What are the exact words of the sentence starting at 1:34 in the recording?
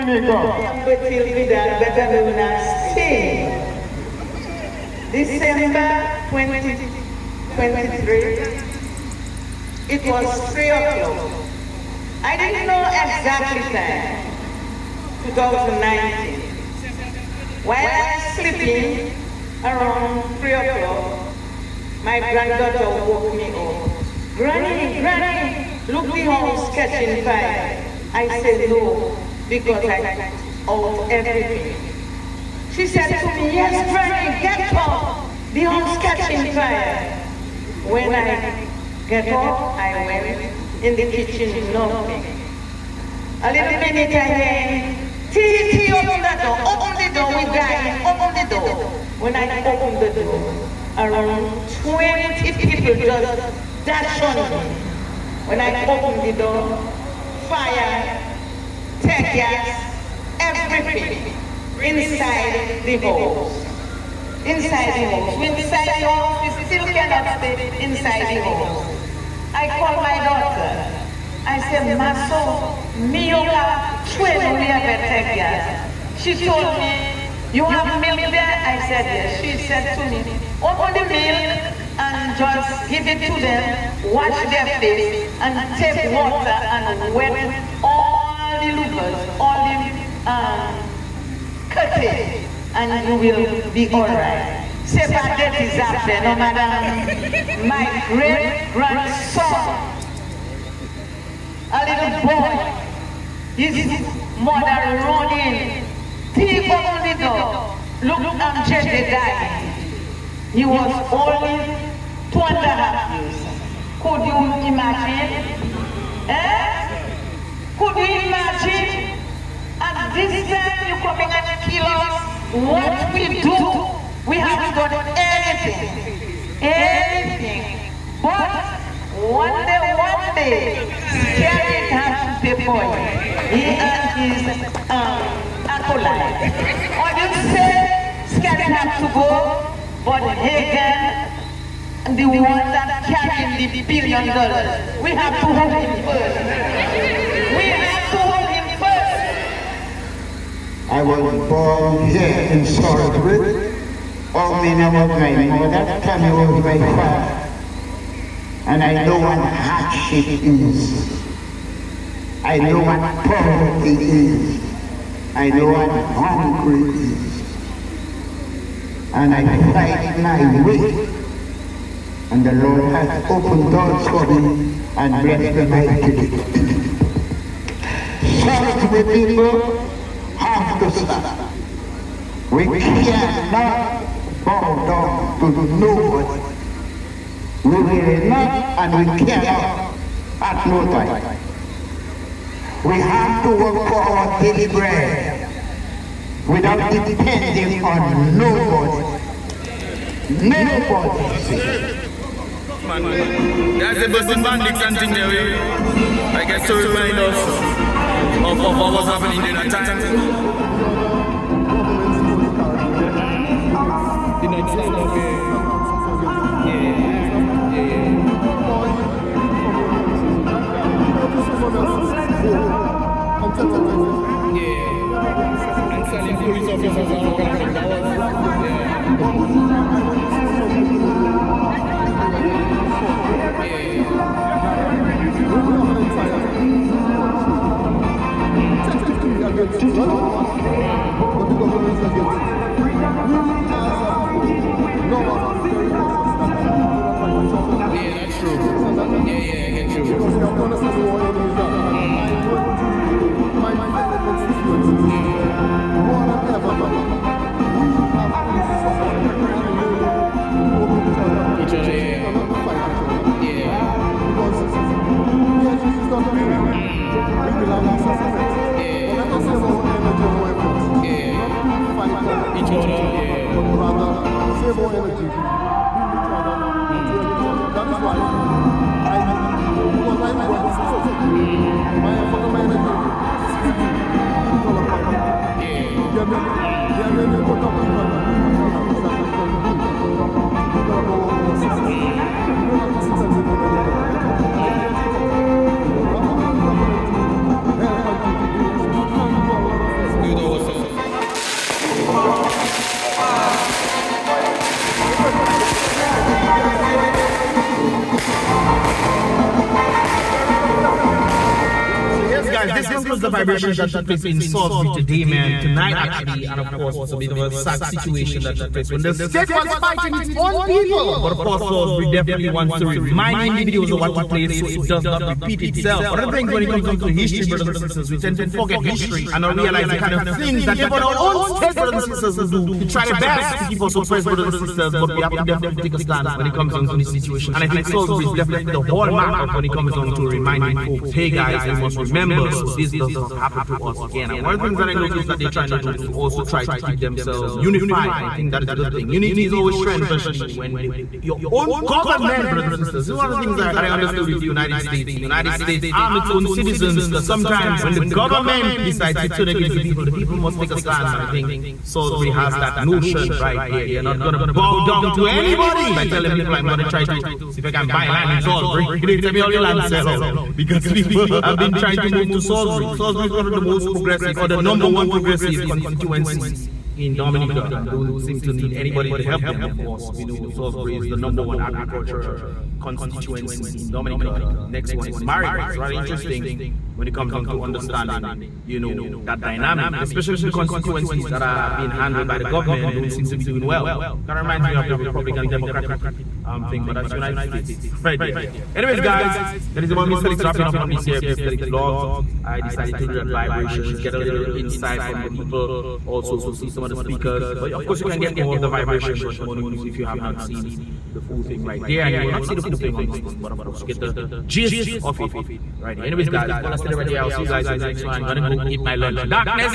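C'est pas is after, no madam.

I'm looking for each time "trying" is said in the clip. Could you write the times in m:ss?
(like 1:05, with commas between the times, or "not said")
5:45, 6:11.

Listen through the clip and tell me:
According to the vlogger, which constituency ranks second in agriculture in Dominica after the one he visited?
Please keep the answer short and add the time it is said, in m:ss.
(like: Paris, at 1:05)
Marigot, at 6:25.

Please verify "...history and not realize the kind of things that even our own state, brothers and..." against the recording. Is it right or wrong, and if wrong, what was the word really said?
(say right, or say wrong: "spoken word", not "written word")
right.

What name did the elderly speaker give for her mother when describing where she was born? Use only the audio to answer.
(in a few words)
Omina.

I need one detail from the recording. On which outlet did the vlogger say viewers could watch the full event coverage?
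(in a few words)
emo news.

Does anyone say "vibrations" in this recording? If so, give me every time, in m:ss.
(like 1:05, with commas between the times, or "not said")
5:13, 6:43, 6:48.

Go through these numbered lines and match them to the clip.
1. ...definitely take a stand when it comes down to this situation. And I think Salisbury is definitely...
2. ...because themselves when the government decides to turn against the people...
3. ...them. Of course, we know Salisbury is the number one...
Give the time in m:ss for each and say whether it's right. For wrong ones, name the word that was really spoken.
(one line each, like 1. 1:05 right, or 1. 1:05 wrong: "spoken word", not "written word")
1. 5:35 right
2. 5:57 wrong: "sometimes", not "themselves"
3. 6:19 right.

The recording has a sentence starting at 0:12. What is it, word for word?
I didn't know exactly time, 2019.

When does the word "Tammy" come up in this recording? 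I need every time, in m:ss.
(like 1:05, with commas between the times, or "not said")
2:36.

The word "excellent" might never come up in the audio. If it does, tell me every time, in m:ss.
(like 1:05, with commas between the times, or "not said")
not said.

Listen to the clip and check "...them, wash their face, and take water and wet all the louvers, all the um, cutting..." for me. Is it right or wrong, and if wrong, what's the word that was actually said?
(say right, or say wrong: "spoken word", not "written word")
right.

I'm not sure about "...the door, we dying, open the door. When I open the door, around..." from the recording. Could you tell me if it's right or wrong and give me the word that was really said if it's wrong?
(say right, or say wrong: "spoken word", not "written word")
right.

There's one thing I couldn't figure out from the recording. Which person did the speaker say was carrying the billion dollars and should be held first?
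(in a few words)
Hagan.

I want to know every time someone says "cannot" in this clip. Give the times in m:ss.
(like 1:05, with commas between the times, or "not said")
1:06, 3:02, 3:09.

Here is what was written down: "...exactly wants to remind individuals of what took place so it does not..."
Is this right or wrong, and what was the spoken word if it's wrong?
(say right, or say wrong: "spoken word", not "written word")
wrong: "definitely", not "exactly".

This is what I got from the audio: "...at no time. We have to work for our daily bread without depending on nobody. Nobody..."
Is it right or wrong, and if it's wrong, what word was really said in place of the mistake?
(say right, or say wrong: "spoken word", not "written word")
right.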